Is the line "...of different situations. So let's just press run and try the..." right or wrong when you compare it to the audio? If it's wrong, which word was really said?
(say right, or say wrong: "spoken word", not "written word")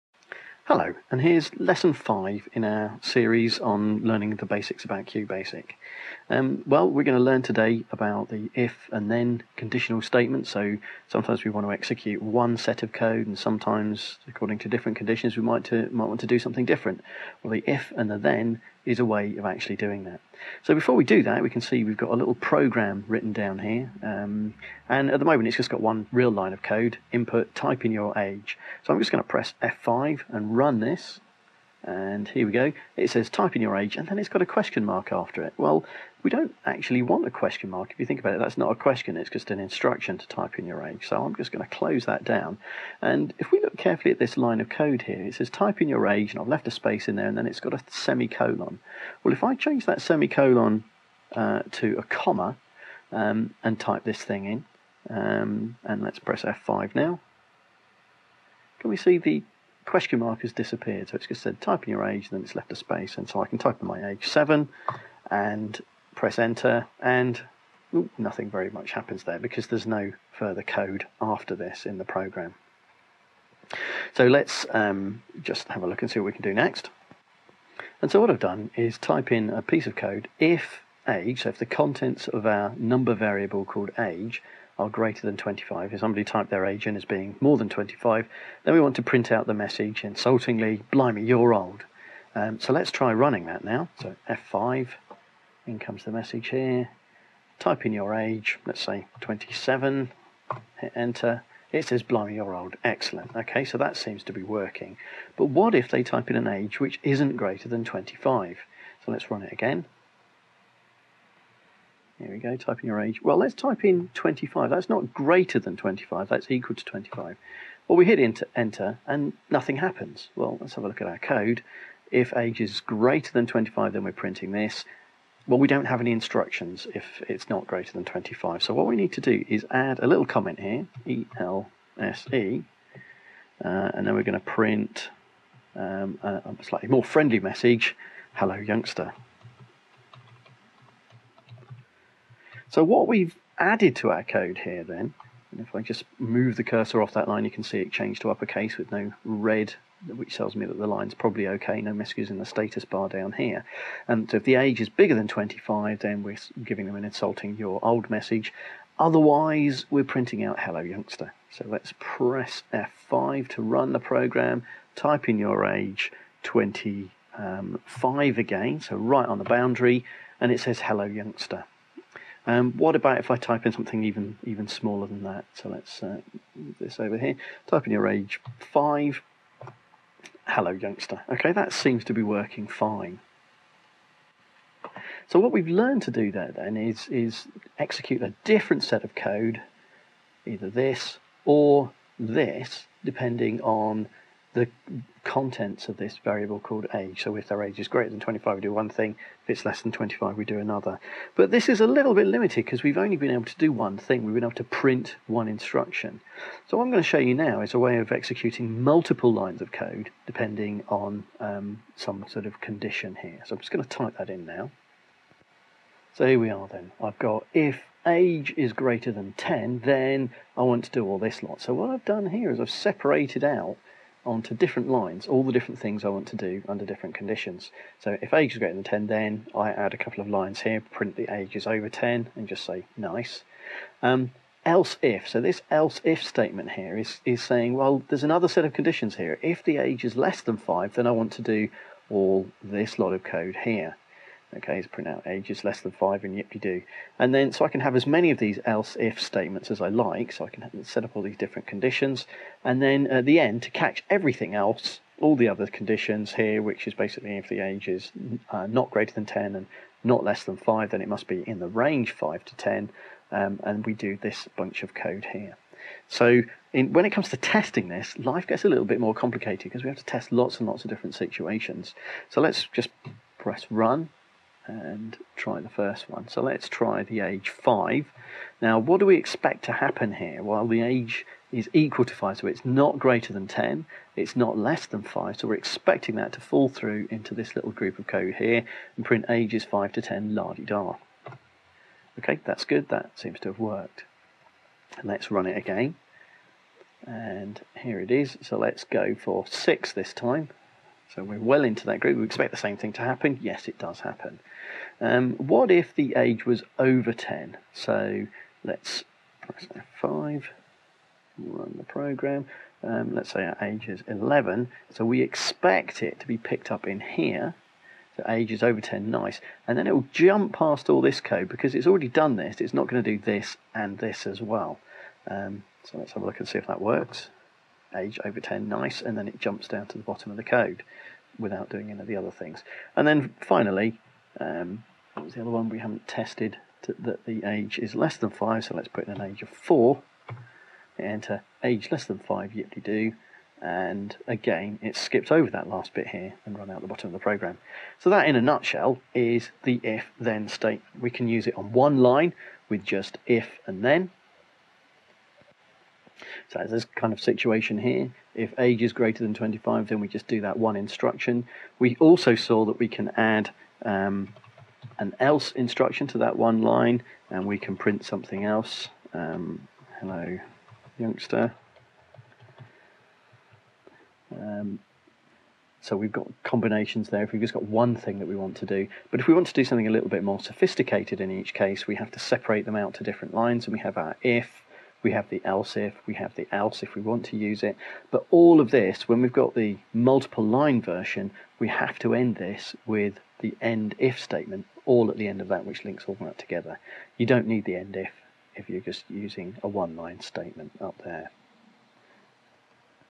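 right.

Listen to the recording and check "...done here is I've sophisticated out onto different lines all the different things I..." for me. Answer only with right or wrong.
wrong.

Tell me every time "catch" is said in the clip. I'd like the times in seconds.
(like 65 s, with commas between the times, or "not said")
253 s.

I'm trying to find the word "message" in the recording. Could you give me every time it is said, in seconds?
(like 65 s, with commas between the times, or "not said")
89 s, 96 s, 137 s, 151 s, 158 s.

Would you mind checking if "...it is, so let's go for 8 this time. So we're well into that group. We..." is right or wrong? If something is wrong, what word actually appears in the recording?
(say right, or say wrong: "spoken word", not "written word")
wrong: "6", not "8".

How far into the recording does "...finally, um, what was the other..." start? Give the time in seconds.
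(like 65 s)
333 s.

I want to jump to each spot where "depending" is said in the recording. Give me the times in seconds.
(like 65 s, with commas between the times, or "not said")
193 s, 210 s.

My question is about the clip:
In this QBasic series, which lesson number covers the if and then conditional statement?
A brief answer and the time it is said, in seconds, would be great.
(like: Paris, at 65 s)
5, at 1 s.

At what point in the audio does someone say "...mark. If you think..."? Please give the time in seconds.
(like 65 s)
37 s.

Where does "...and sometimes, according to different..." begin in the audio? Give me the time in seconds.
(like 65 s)
13 s.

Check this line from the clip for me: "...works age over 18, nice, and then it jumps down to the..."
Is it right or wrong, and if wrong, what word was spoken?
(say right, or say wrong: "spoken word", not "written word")
wrong: "10", not "18".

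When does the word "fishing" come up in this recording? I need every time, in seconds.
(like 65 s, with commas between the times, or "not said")
not said.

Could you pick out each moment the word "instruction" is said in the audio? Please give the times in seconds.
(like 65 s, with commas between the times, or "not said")
39 s, 126 s, 205 s, 360 s, 365 s.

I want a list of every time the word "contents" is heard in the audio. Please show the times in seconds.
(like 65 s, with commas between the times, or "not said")
81 s, 195 s.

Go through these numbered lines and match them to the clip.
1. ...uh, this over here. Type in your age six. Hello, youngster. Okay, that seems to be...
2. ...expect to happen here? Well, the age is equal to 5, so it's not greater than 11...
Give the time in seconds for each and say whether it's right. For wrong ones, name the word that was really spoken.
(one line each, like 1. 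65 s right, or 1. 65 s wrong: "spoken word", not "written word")
1. 176 s wrong: "five", not "six"
2. 279 s wrong: "10", not "11".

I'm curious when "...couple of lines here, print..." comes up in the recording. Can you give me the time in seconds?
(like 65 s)
229 s.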